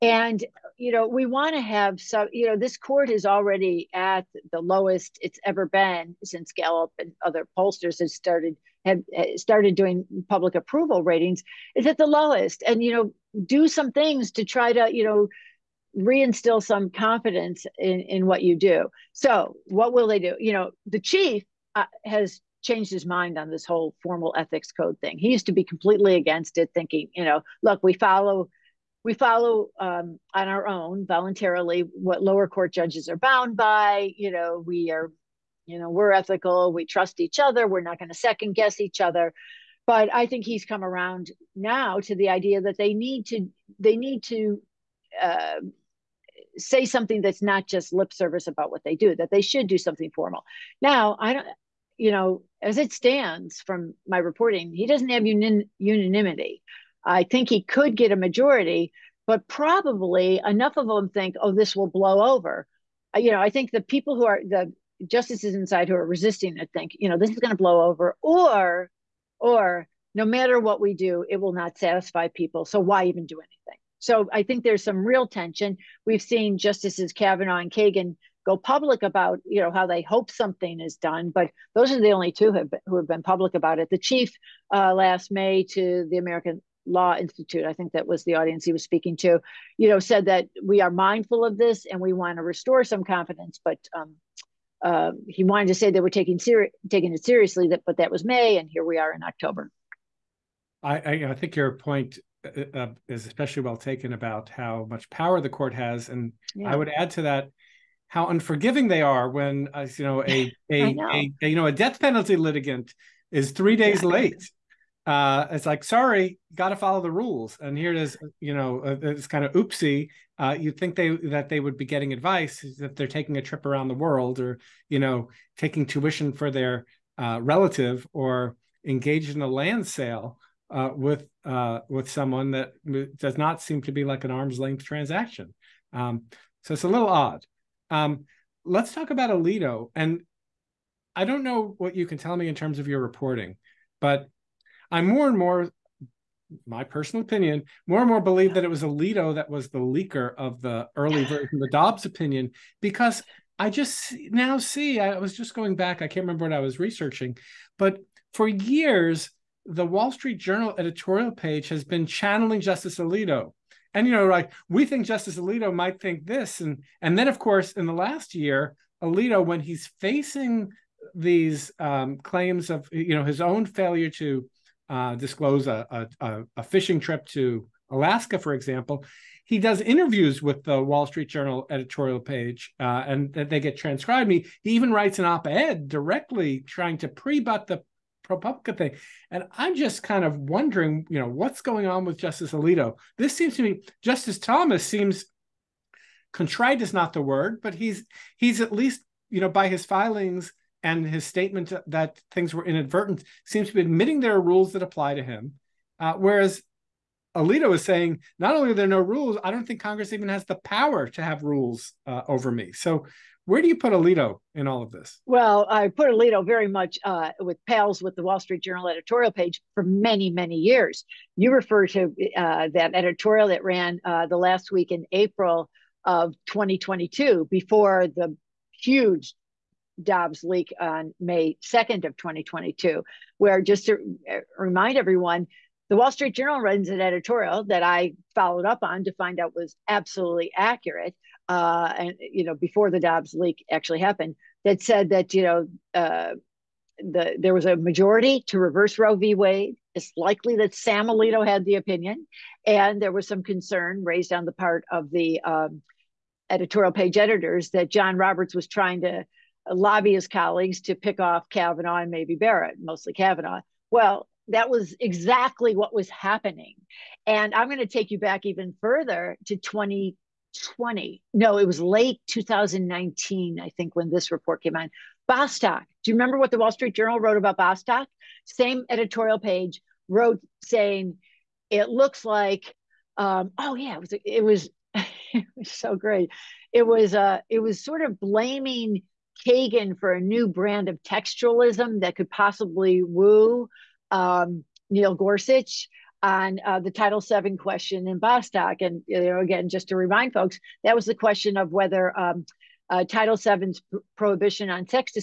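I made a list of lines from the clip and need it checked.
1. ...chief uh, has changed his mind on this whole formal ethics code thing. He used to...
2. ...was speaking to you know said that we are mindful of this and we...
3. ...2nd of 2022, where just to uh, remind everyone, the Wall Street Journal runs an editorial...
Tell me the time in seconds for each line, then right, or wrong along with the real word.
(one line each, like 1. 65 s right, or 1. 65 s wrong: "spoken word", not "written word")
1. 20 s right
2. 88 s right
3. 231 s right.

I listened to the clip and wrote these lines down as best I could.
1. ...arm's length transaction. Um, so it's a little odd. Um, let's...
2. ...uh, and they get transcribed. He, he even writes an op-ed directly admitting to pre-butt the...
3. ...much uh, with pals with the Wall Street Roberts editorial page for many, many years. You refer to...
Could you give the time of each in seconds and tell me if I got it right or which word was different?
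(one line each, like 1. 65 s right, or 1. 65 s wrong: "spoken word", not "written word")
1. 134 s right
2. 182 s wrong: "trying", not "admitting"
3. 216 s wrong: "Journal", not "Roberts".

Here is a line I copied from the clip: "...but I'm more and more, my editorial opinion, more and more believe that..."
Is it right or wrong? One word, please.
wrong.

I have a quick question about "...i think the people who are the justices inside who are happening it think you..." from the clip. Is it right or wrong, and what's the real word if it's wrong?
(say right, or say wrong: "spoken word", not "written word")
wrong: "resisting", not "happening".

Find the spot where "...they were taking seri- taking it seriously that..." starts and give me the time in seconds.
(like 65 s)
95 s.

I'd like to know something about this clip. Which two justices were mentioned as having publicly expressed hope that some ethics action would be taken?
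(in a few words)
Kavanaugh and Kagan.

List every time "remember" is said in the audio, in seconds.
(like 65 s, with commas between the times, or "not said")
156 s, 276 s.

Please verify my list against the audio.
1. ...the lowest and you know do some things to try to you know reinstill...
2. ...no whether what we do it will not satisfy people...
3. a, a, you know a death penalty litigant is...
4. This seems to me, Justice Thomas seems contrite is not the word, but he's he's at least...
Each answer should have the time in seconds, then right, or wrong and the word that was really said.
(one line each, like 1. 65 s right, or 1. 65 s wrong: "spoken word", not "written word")
1. 11 s right
2. 70 s wrong: "matter", not "whether"
3. 111 s right
4. 193 s right.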